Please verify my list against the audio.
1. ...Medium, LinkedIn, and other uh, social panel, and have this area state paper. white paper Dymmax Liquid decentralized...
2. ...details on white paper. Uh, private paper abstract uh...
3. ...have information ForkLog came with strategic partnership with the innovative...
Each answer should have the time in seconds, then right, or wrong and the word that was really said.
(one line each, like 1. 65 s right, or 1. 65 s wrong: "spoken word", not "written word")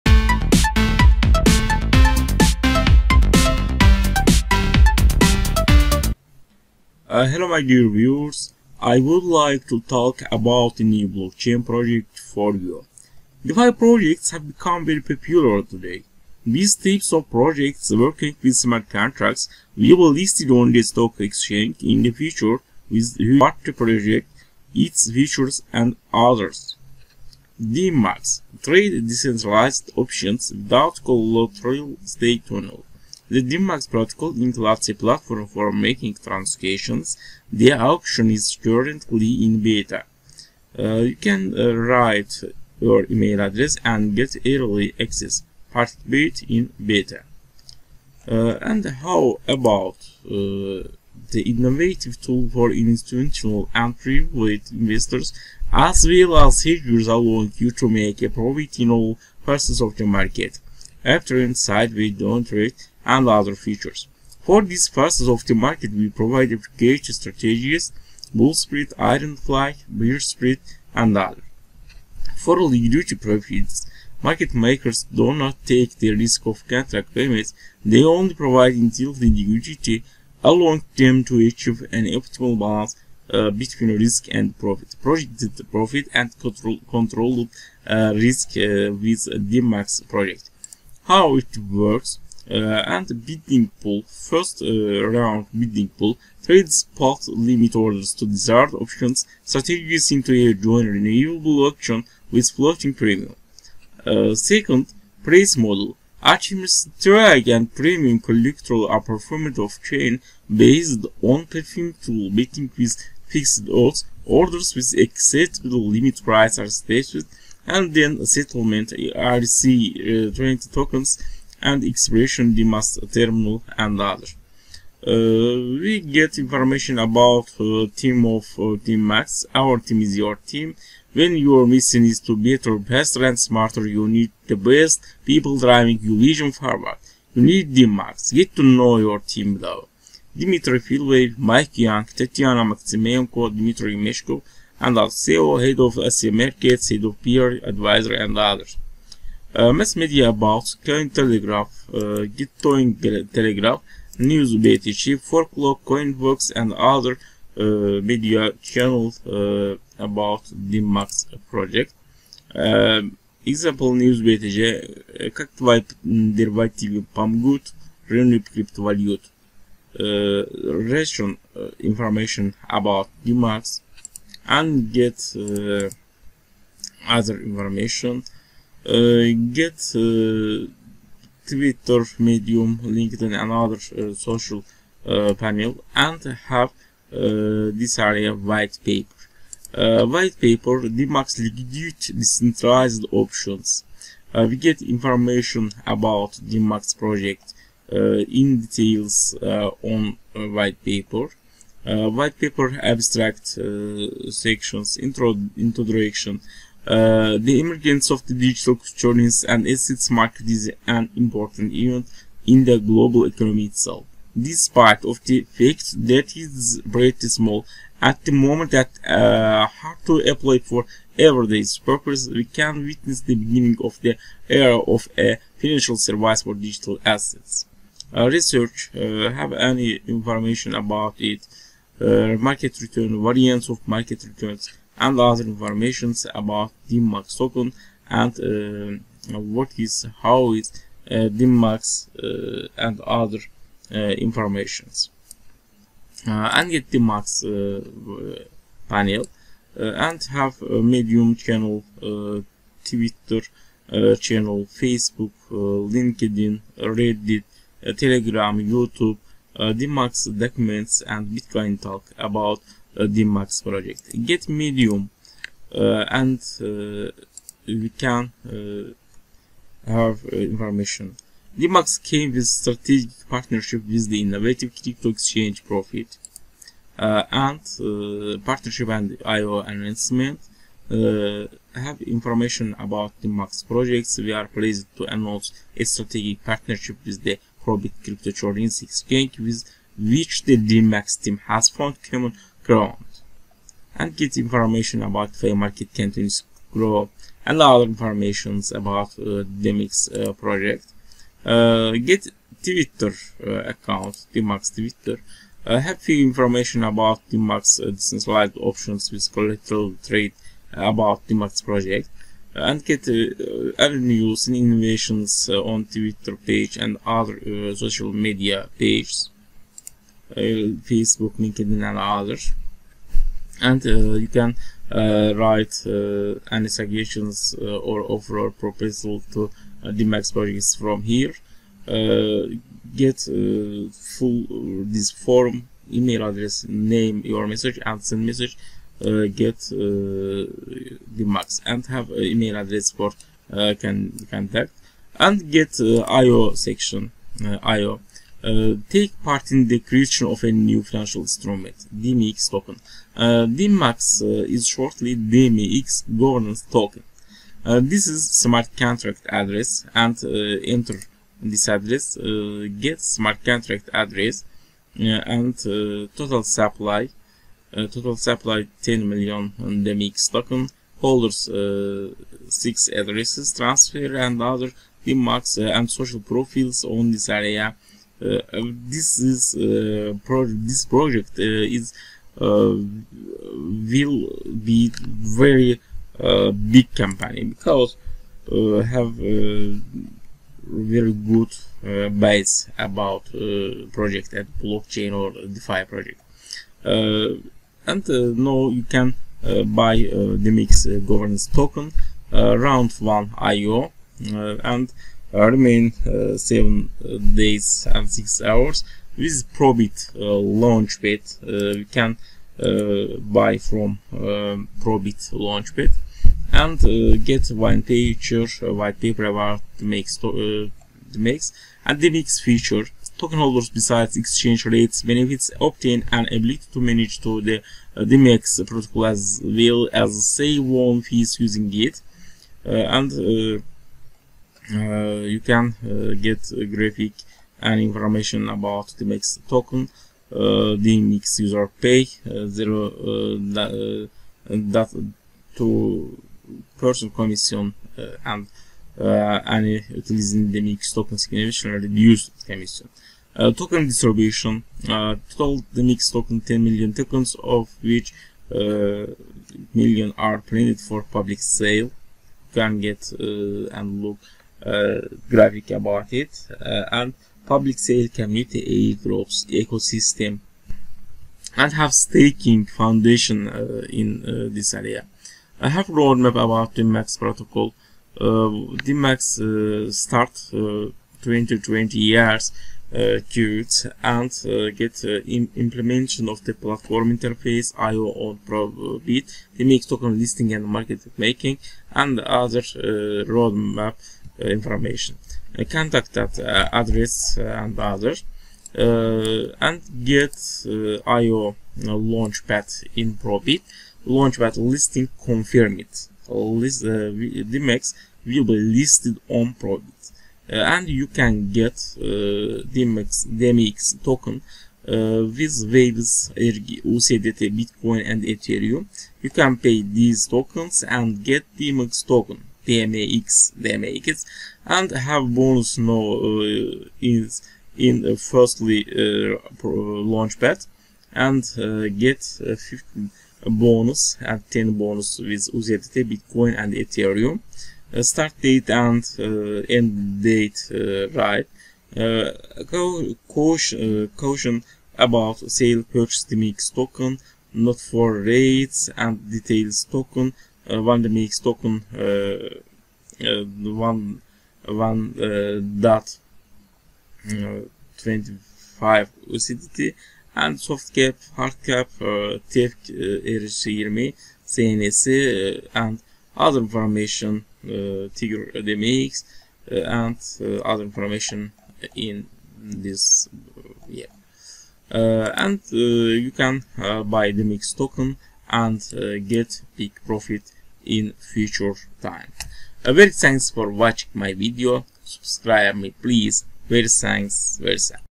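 1. 182 s wrong: "white", not "state"
2. 198 s wrong: "white", not "private"
3. 269 s wrong: "Dymmax", not "ForkLog".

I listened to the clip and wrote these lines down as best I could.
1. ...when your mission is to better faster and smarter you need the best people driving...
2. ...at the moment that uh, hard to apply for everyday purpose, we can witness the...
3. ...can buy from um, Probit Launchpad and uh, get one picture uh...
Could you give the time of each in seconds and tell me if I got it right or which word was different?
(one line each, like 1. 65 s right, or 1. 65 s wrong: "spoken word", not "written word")
1. 131 s right
2. 218 s right
3. 411 s right.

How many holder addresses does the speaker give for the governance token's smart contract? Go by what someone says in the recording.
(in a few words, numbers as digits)
6.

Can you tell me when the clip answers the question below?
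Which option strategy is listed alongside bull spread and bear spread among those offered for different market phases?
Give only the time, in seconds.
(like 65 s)
68 s.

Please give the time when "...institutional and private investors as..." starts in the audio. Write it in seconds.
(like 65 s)
52 s.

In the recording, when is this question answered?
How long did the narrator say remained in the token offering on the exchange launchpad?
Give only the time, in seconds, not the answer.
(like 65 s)
406 s.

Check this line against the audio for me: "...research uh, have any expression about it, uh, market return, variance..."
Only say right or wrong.
wrong.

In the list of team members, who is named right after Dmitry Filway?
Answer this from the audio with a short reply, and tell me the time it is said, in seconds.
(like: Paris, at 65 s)
Mike Young, at 141 s.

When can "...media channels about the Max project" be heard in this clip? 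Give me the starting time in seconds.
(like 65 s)
158 s.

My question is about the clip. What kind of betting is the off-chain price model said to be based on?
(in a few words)
Parimutuel betting.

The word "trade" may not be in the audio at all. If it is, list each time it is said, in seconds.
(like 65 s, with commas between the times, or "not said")
28 s, 96 s, 310 s.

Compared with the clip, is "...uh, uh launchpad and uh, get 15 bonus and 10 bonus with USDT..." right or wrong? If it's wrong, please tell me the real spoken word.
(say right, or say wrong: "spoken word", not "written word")
right.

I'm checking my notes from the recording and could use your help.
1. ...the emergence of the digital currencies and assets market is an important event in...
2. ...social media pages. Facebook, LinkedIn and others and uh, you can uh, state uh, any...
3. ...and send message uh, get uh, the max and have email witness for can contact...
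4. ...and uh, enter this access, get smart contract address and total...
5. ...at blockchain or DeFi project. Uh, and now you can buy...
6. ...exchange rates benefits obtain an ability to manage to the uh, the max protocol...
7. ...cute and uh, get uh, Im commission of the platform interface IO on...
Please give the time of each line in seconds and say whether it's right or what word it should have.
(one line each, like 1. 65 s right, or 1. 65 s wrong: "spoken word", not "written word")
1. 207 s right
2. 317 s wrong: "write", not "state"
3. 337 s wrong: "address", not "witness"
4. 359 s wrong: "address", not "access"
5. 394 s right
6. 424 s right
7. 483 s wrong: "implementation", not "commission".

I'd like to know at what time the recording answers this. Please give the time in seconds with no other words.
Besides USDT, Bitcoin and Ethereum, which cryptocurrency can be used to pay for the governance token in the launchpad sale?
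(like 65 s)
515 s.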